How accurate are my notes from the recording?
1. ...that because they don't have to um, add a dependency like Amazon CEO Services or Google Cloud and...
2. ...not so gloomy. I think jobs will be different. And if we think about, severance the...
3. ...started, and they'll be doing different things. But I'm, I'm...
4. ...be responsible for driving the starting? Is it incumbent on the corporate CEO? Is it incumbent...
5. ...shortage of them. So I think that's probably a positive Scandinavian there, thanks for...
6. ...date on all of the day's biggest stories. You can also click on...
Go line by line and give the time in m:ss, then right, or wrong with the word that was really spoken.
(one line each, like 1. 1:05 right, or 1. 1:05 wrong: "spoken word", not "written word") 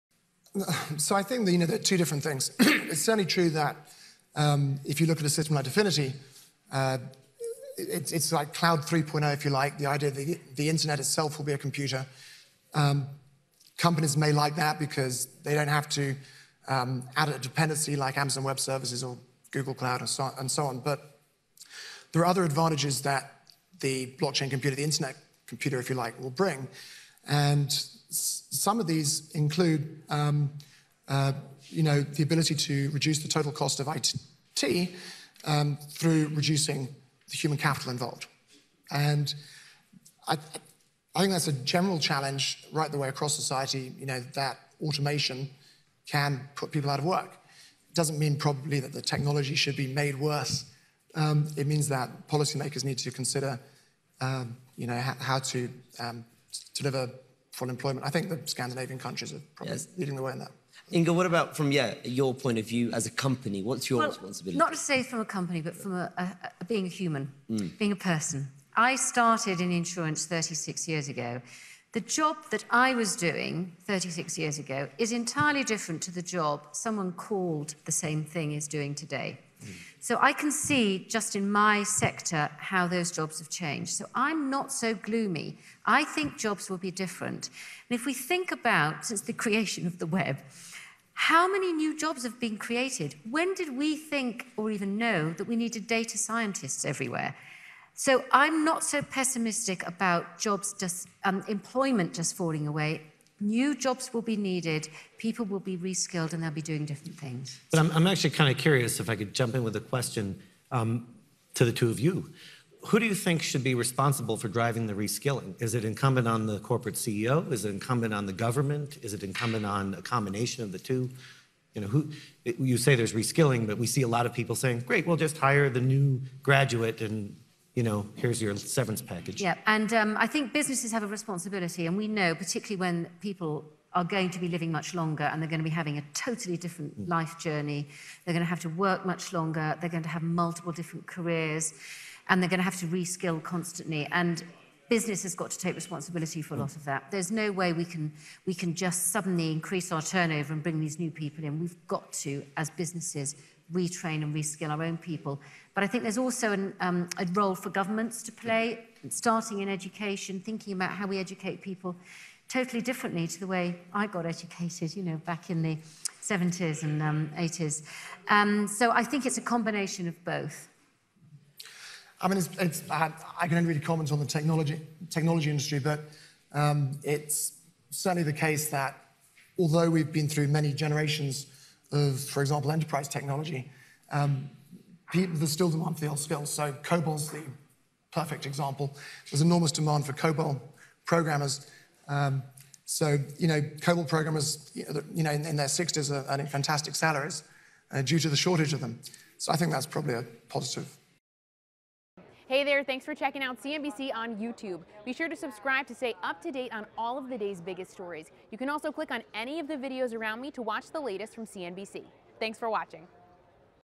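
1. 0:14 wrong: "Web", not "CEO"
2. 1:24 wrong: "since", not "severance"
3. 1:45 wrong: "reskilled", not "started"
4. 1:53 wrong: "reskilling", not "starting"
5. 3:18 wrong: "Hey", not "Scandinavian"
6. 3:26 right.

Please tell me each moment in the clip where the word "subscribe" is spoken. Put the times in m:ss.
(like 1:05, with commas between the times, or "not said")
3:25.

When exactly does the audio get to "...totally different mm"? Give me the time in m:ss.
2:16.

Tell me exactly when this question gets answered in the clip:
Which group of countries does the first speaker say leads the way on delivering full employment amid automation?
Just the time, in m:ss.
0:58.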